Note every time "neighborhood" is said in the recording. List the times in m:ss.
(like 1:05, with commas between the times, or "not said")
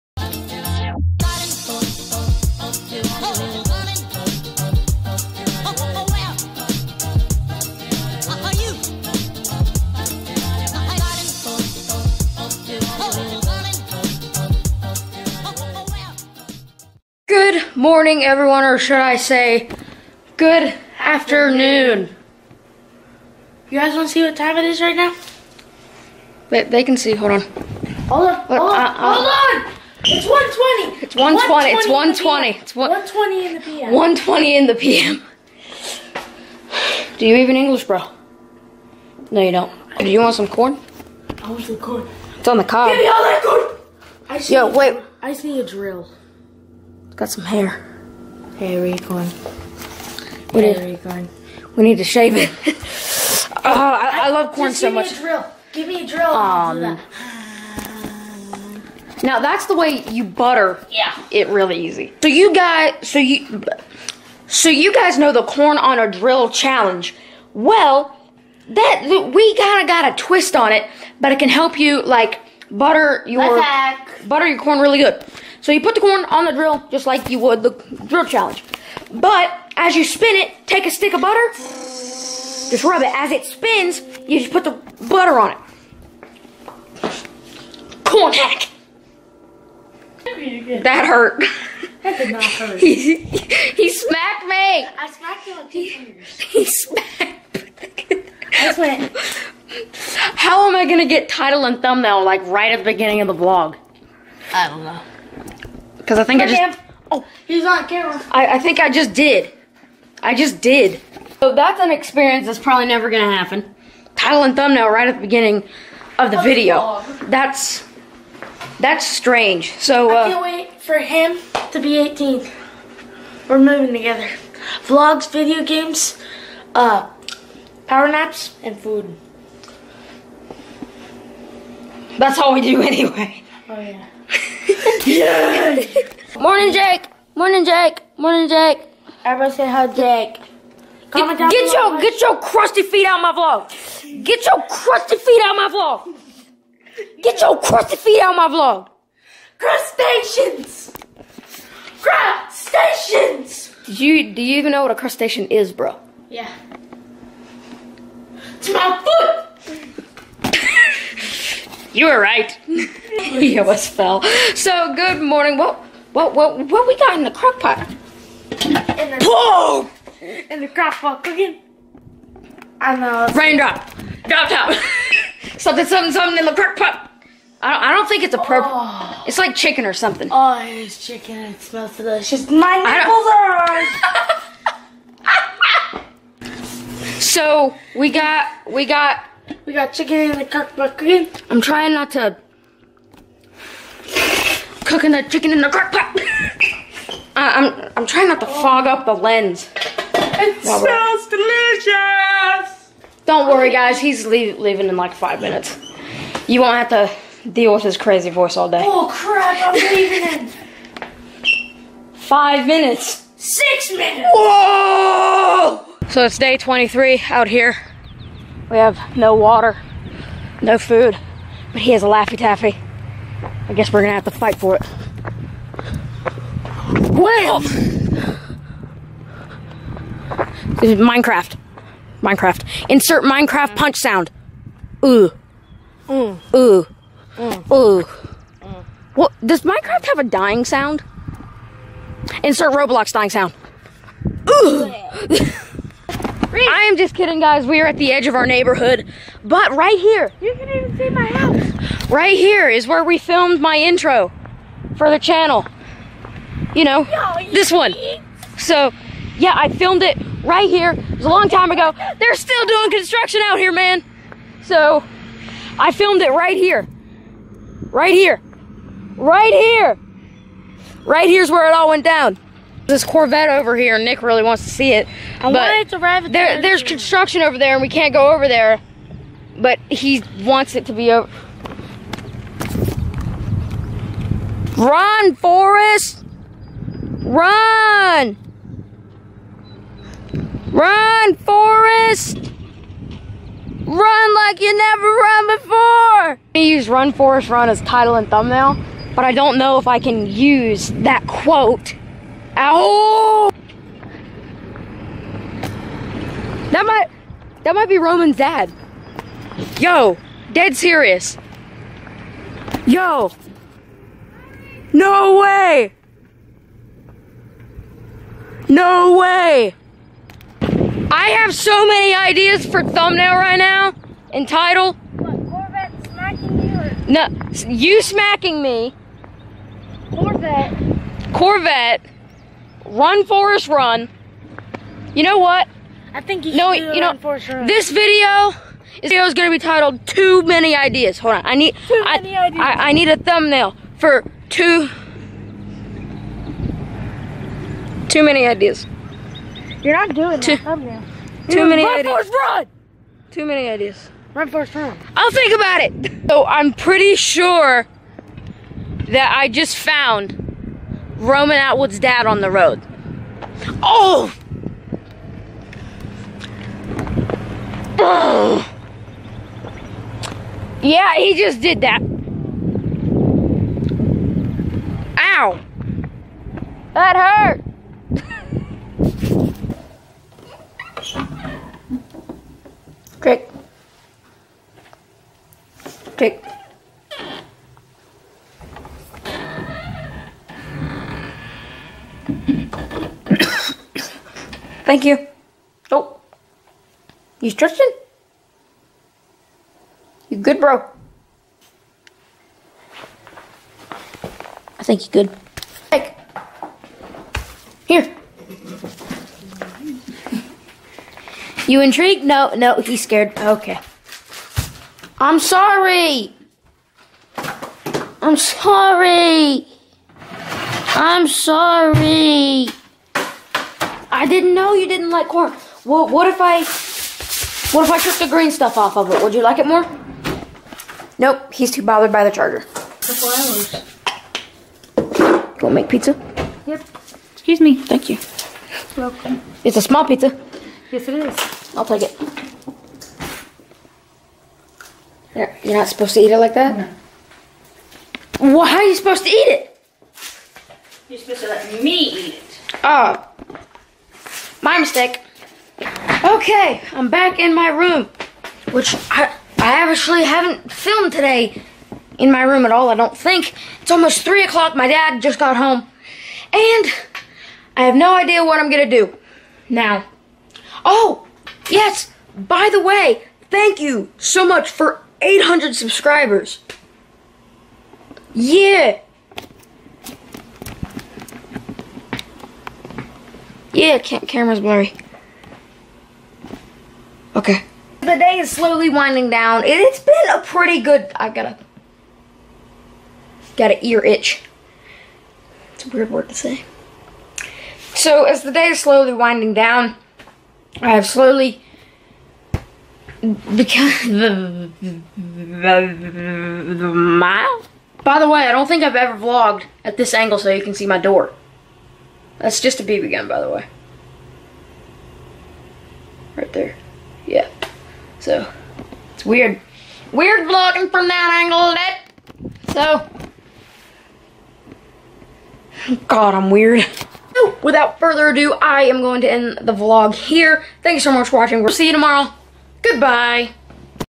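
4:08.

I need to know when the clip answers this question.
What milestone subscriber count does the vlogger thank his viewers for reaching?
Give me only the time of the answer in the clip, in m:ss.
7:55.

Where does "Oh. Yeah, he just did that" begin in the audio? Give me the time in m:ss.
6:07.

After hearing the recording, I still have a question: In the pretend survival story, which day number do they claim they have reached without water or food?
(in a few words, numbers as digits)
23.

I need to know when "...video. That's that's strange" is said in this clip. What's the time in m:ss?
1:56.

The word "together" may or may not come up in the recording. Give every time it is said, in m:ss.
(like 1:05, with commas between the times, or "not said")
2:03.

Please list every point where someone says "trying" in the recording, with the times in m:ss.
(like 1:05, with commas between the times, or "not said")
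3:11, 3:18.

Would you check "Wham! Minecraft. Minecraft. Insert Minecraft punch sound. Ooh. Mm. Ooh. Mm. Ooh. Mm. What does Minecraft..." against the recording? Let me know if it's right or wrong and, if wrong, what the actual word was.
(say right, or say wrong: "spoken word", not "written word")
right.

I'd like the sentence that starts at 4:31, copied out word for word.
Right here's where it all went down this Corvette over here.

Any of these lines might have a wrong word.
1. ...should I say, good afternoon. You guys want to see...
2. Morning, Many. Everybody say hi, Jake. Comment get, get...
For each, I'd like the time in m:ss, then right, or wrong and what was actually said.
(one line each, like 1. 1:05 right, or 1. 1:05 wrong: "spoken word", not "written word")
1. 0:18 right
2. 2:18 wrong: "Jake", not "Many".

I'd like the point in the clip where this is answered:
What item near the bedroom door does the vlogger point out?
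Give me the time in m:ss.
8:32.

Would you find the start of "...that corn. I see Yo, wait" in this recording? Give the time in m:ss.
0:43.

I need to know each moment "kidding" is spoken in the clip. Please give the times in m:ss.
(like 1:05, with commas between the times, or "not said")
4:07.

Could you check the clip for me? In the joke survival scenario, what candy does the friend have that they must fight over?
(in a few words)
Laffy Taffy.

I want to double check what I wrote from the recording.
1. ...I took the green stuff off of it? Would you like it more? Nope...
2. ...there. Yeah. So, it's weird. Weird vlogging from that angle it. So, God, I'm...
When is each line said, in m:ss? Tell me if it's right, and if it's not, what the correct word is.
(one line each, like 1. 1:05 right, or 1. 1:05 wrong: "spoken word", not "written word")
1. 7:07 right
2. 8:36 right.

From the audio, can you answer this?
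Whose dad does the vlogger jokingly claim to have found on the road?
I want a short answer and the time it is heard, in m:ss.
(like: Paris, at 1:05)
Roman Atwood's, at 6:01.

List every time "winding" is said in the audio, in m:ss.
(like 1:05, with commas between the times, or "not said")
8:08, 8:19.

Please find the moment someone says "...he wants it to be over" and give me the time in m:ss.
4:39.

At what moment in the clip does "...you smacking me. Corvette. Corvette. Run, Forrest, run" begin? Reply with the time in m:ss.
5:27.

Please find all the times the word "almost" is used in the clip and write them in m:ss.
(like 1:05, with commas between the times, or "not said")
2:43, 7:43.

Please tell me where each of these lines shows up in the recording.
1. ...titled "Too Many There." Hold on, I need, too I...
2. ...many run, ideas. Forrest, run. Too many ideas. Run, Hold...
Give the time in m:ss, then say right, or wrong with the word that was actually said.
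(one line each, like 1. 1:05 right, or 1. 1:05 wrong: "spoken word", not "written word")
1. 5:39 wrong: "Ideas", not "There"
2. 5:51 wrong: "Forrest", not "Hold".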